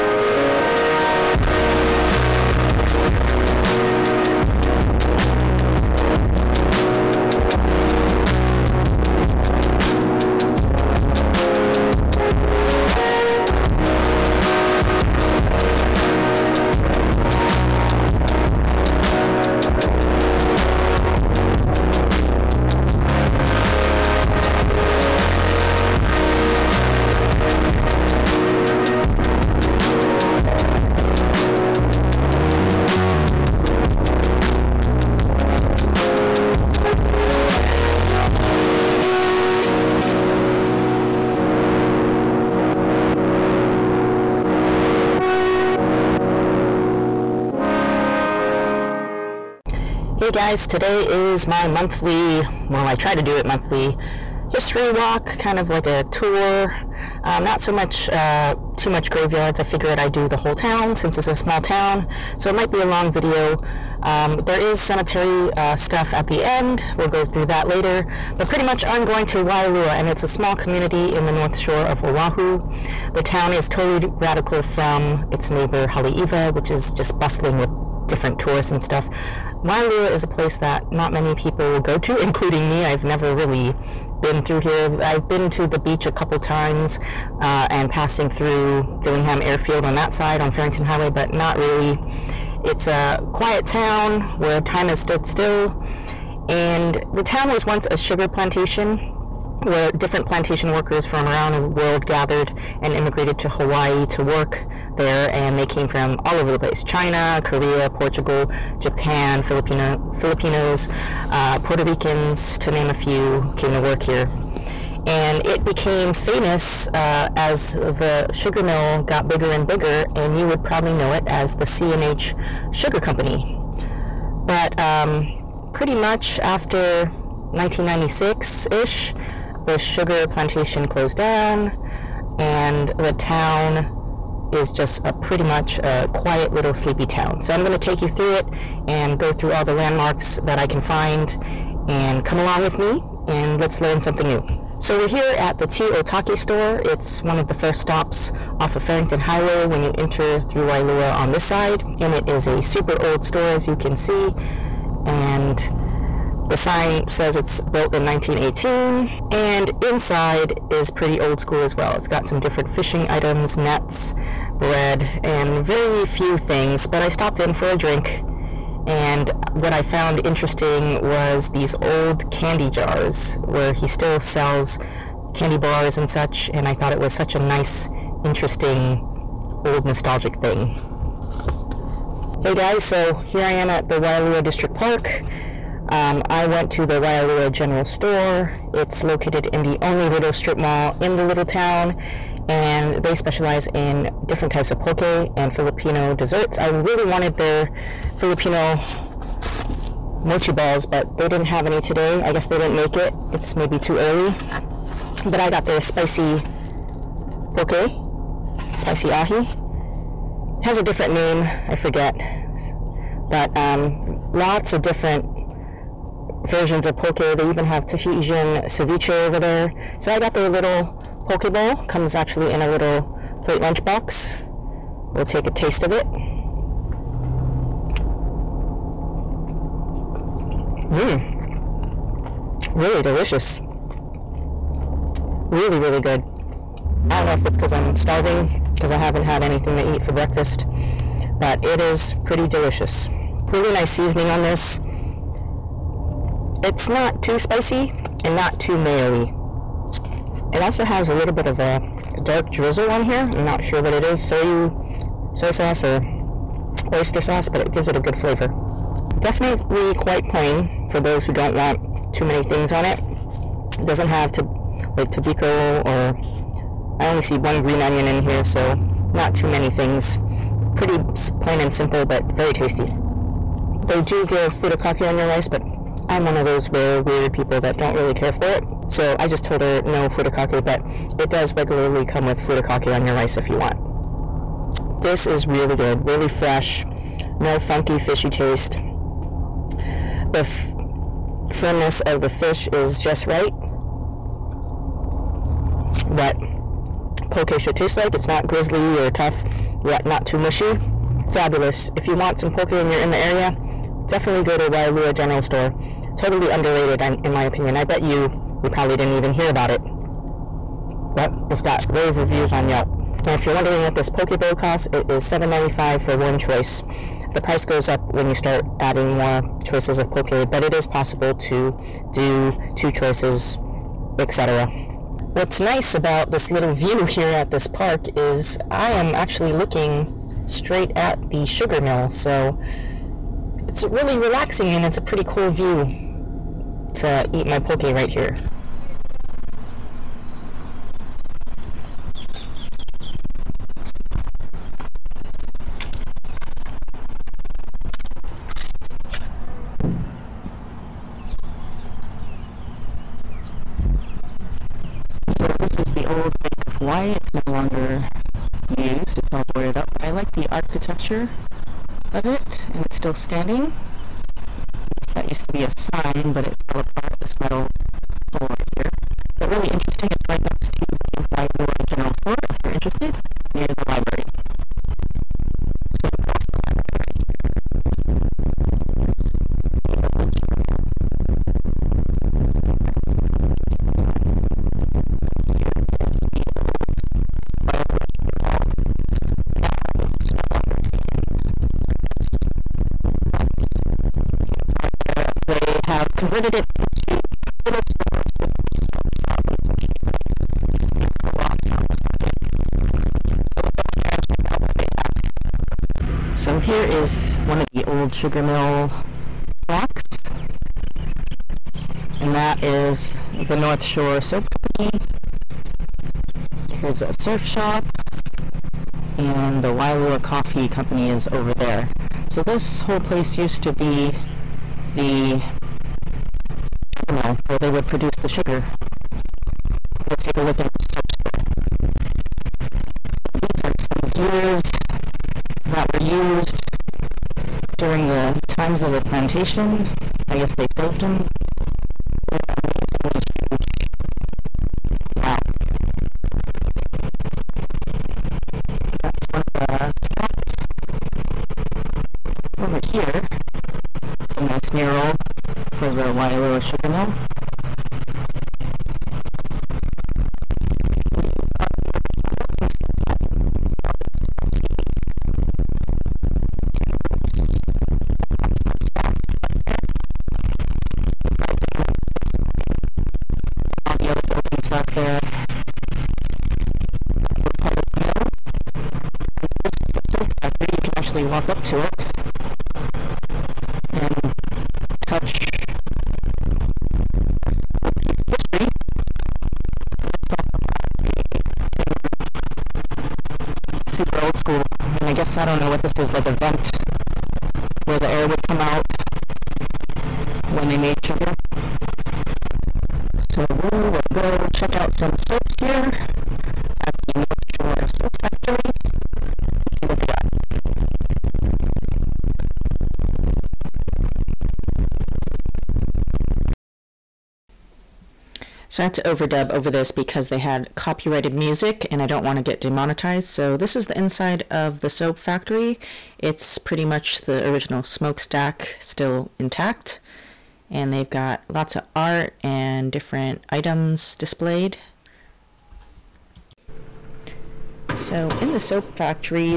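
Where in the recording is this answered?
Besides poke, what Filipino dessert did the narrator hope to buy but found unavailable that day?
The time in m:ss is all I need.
3:18.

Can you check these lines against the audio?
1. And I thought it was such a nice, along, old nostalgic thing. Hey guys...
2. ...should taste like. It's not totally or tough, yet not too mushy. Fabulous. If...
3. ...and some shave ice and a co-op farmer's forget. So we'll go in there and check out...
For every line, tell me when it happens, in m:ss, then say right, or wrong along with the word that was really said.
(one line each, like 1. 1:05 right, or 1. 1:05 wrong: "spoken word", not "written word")
1. 2:56 wrong: "interesting", not "along"
2. 4:57 wrong: "grizzly", not "totally"
3. 6:39 wrong: "market", not "forget".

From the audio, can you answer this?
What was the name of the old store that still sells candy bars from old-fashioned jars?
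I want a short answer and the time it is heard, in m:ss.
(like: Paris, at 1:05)
T Otake store, at 2:25.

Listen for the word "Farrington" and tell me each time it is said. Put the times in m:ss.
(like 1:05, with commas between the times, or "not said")
1:30, 2:28.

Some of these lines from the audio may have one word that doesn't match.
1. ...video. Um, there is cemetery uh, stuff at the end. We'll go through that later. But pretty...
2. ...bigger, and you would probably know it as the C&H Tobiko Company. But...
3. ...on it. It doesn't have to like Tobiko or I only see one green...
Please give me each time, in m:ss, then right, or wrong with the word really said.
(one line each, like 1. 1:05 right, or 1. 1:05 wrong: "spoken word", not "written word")
1. 1:03 right
2. 1:59 wrong: "Sugar", not "Tobiko"
3. 4:22 right.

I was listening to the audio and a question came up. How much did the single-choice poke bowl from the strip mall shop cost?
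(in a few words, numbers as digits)
$7.95.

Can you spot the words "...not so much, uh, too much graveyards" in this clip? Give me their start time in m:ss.
0:57.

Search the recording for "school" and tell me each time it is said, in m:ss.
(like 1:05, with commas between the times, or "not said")
2:41, 8:14.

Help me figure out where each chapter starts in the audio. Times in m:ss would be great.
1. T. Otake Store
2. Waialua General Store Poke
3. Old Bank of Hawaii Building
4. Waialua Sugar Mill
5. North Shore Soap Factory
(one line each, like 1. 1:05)
1. 2:24
2. 3:04
3. 5:38
4. 6:14
5. 8:22.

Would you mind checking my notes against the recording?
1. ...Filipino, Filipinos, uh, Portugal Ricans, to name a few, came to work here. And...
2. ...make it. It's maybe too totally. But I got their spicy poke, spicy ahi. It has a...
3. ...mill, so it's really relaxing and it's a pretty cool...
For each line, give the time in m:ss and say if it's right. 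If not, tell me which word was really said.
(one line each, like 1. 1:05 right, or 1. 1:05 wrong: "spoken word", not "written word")
1. 1:49 wrong: "Puerto", not "Portugal"
2. 3:22 wrong: "early", not "totally"
3. 5:31 right.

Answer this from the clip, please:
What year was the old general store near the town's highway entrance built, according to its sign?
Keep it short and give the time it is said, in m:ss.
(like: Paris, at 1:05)
1918, at 2:38.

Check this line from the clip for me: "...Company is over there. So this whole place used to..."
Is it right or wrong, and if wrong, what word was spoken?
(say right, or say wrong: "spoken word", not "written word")
right.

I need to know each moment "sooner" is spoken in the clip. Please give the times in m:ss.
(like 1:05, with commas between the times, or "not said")
not said.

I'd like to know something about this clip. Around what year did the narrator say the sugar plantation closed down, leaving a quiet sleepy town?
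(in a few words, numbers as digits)
1996.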